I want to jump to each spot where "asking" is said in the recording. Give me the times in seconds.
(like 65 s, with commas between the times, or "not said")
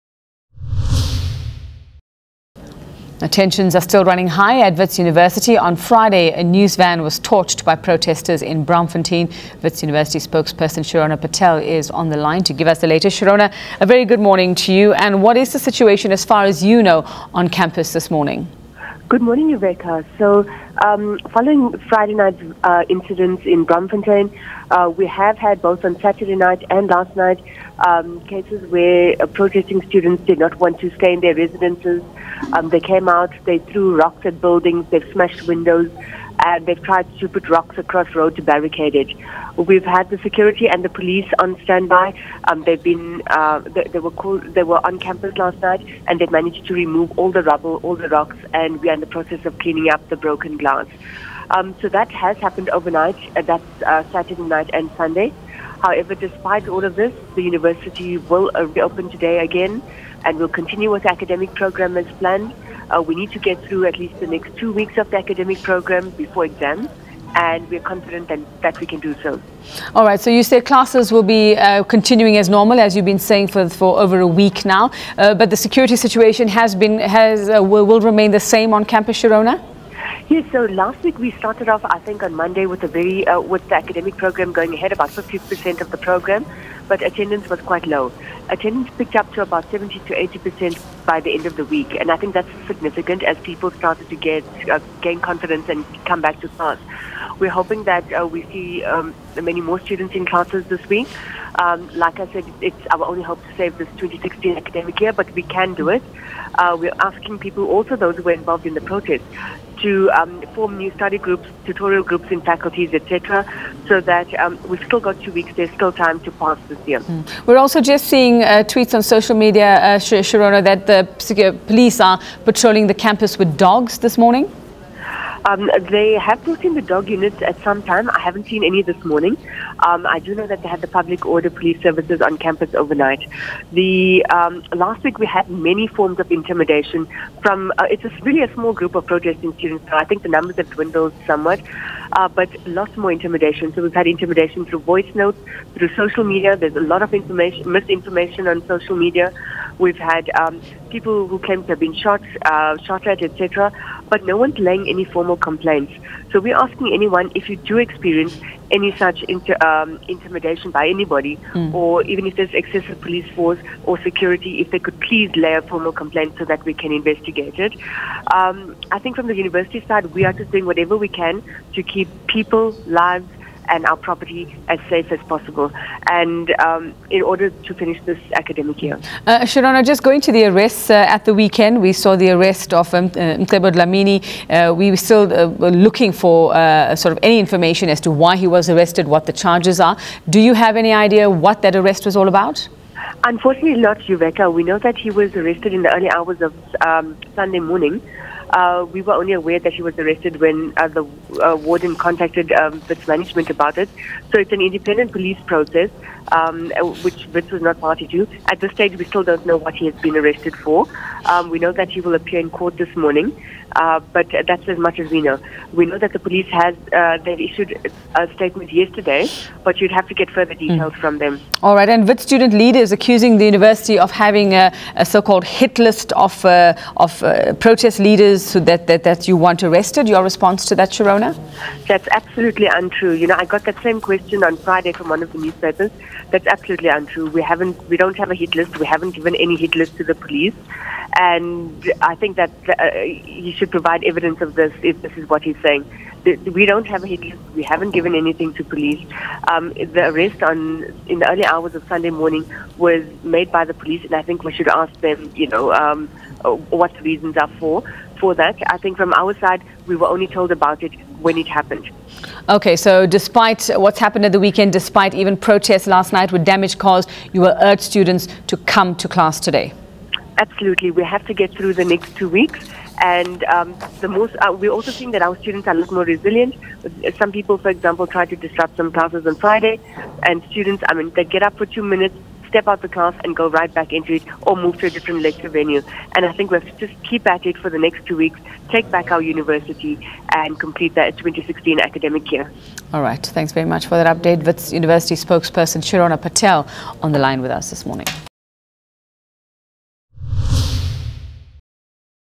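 107 s, 156 s.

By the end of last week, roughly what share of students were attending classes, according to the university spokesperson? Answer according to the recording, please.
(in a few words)
70 to 80%.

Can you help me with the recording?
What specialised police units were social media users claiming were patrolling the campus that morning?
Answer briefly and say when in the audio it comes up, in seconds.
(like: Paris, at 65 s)
Dog units, at 126 s.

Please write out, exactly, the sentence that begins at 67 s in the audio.
And we're confident that, that we can do so.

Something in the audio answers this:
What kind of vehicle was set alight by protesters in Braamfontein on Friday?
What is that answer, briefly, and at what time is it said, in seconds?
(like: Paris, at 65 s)
News van, at 6 s.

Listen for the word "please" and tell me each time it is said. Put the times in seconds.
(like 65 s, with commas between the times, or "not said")
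164 s.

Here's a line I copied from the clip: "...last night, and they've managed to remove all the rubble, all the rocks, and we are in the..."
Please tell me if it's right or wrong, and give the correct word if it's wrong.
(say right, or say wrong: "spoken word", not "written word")
right.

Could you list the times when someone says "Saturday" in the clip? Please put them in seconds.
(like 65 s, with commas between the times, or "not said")
25 s, 54 s.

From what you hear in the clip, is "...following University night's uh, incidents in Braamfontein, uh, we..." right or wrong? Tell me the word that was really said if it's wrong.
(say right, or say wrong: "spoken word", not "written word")
wrong: "Friday", not "University".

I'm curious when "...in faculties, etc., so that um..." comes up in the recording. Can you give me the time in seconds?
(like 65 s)
112 s.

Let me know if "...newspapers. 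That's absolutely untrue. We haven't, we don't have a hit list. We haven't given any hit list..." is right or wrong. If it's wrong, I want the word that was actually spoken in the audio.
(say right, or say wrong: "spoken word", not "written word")
right.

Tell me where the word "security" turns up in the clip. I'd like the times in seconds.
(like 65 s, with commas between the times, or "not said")
40 s, 75 s, 164 s.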